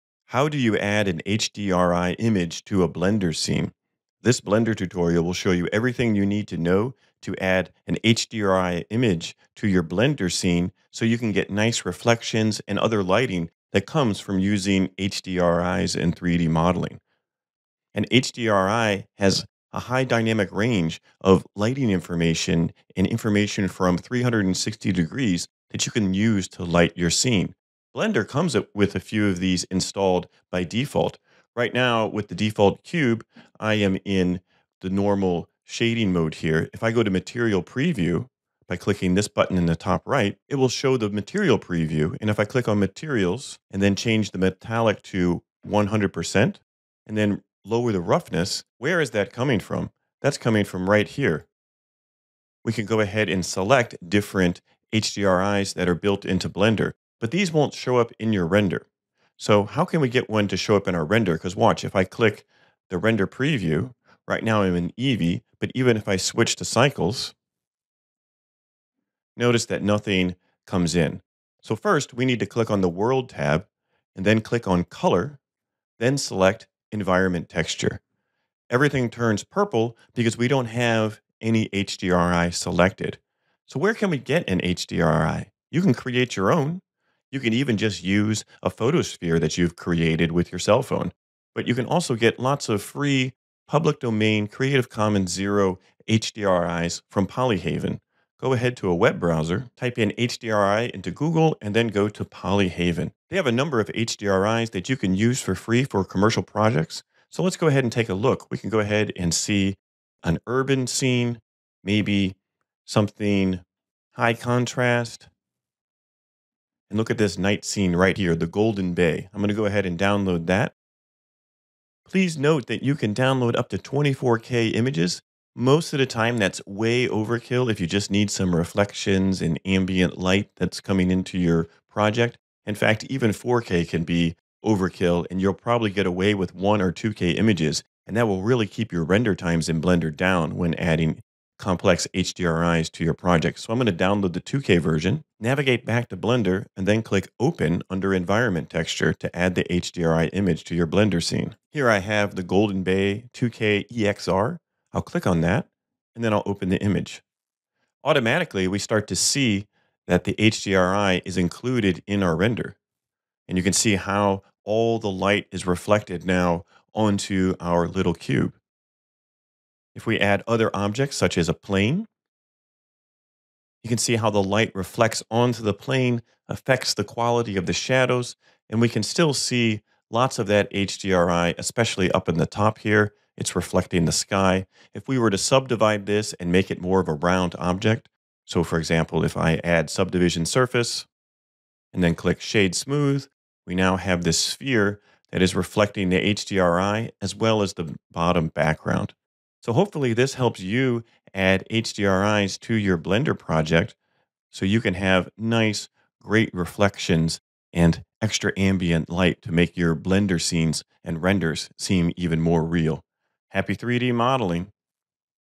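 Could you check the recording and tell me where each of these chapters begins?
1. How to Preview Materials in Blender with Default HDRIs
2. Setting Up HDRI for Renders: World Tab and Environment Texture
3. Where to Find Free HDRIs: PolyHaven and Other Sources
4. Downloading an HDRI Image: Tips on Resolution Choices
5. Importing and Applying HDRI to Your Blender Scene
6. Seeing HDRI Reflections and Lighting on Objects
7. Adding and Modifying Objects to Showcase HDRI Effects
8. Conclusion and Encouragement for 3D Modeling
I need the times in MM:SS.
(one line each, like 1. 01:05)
1. 00:35
2. 01:05
3. 01:23
4. 01:57
5. 02:25
6. 02:36
7. 02:50
8. 03:15.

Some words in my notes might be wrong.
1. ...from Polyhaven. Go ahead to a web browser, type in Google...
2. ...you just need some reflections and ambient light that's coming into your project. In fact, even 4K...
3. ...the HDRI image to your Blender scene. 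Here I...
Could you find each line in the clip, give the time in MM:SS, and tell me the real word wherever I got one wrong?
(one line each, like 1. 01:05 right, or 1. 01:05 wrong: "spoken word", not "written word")
1. 01:37 wrong: "HDRI", not "Google"
2. 02:07 right
3. 02:29 right.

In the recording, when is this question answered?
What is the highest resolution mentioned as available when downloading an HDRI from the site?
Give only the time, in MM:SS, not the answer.
02:03.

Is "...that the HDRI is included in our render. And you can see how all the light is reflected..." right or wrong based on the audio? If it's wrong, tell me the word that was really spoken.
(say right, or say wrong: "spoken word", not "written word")
right.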